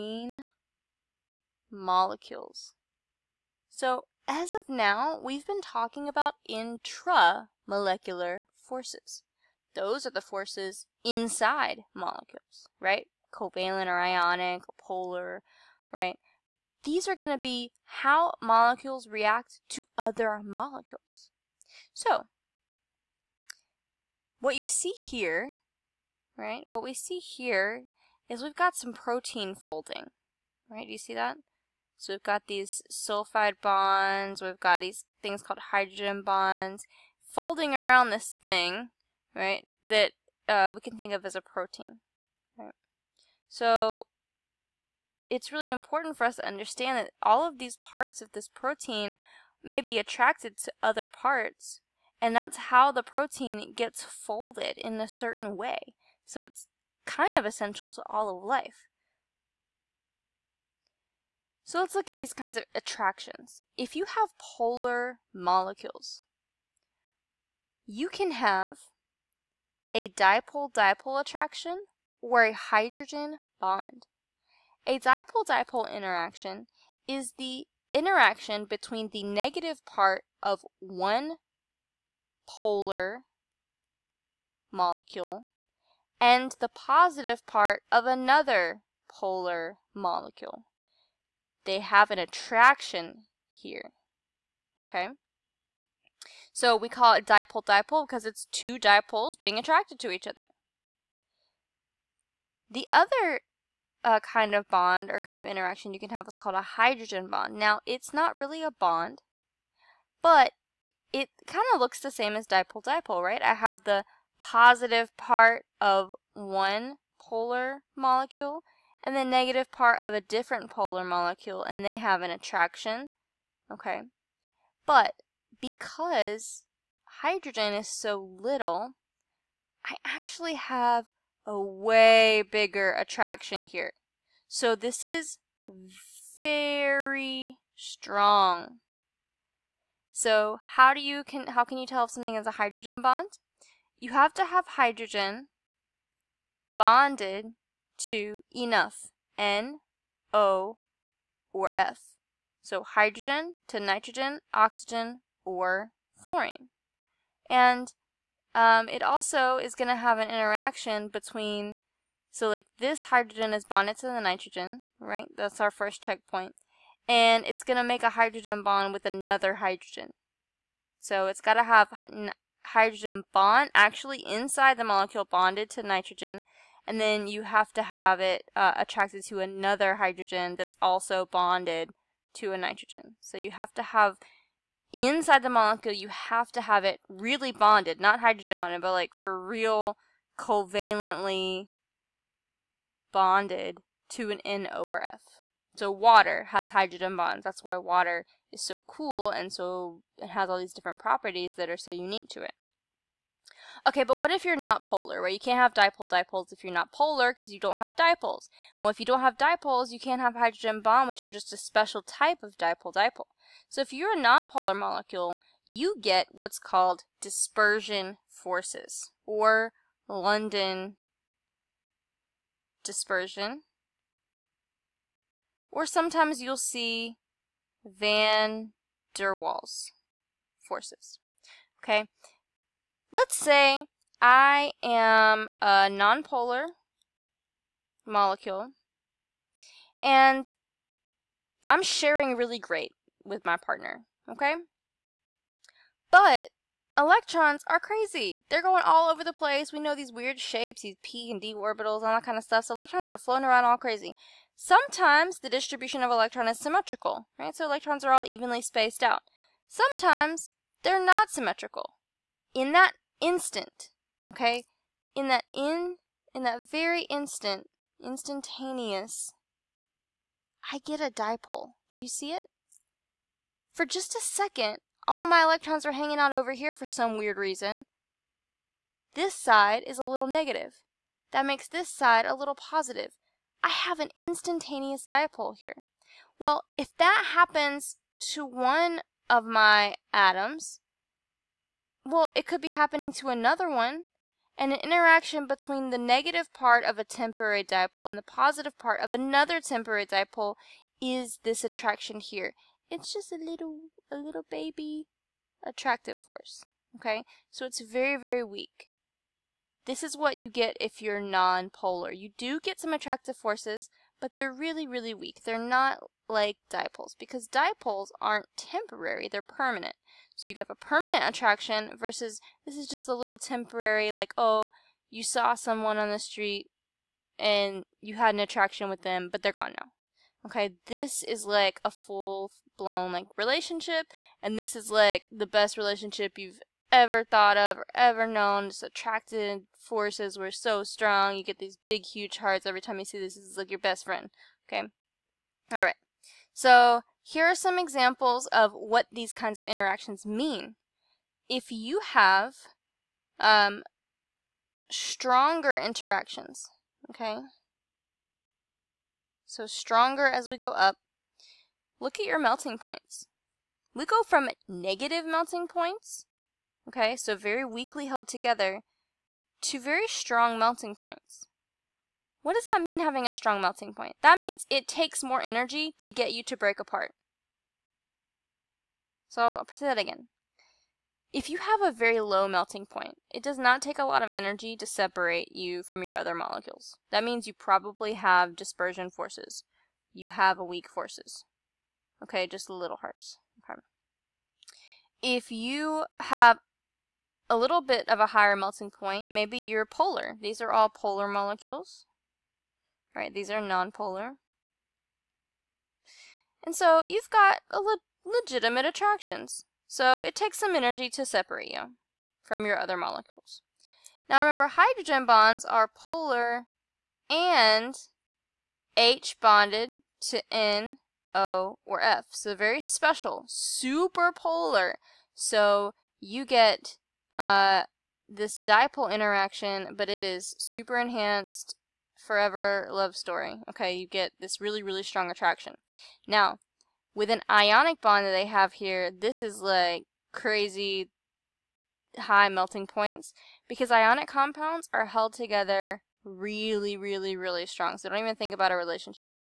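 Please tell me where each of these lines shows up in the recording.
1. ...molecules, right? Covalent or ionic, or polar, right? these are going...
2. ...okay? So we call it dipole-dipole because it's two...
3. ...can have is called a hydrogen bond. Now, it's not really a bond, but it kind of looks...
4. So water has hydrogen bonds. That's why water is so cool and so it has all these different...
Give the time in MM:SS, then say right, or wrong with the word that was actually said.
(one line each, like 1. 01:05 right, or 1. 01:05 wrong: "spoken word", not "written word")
1. 00:11 right
2. 01:34 right
3. 01:46 right
4. 03:15 right.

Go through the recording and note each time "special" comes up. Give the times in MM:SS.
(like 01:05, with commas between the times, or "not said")
03:31, 07:02.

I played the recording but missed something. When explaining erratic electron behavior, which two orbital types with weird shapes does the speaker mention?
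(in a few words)
p and d orbitals.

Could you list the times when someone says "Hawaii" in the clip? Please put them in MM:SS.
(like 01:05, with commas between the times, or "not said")
not said.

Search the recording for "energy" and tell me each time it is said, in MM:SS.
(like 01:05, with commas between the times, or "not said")
06:15, 06:24, 06:50.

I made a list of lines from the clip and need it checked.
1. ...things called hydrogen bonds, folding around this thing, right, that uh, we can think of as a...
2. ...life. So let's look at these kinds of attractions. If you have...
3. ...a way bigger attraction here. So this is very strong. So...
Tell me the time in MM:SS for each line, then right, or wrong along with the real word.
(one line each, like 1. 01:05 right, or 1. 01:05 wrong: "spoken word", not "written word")
1. 00:35 right
2. 00:58 right
3. 02:11 right.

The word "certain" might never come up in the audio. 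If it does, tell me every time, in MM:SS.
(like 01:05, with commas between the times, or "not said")
00:55.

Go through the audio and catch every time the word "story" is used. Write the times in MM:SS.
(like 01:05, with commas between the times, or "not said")
07:13.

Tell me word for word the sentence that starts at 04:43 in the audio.
I have an instantaneous dipole here.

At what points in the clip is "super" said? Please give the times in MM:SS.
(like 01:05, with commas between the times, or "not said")
07:03, 07:10.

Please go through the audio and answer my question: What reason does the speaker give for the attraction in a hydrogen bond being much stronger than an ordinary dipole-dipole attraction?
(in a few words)
hydrogen is so little.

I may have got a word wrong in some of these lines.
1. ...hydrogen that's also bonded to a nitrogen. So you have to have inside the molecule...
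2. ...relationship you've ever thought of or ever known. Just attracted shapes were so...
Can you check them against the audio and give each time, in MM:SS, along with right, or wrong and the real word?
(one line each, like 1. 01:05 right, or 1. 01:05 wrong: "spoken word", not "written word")
1. 02:59 right
2. 05:35 wrong: "forces", not "shapes".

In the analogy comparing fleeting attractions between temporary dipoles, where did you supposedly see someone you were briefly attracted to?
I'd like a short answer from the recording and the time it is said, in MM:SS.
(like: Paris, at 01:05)
on the street, at 05:25.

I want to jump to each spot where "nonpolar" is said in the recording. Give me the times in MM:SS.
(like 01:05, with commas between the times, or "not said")
03:34, 03:55, 06:43.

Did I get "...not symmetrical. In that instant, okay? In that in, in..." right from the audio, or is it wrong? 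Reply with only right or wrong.
right.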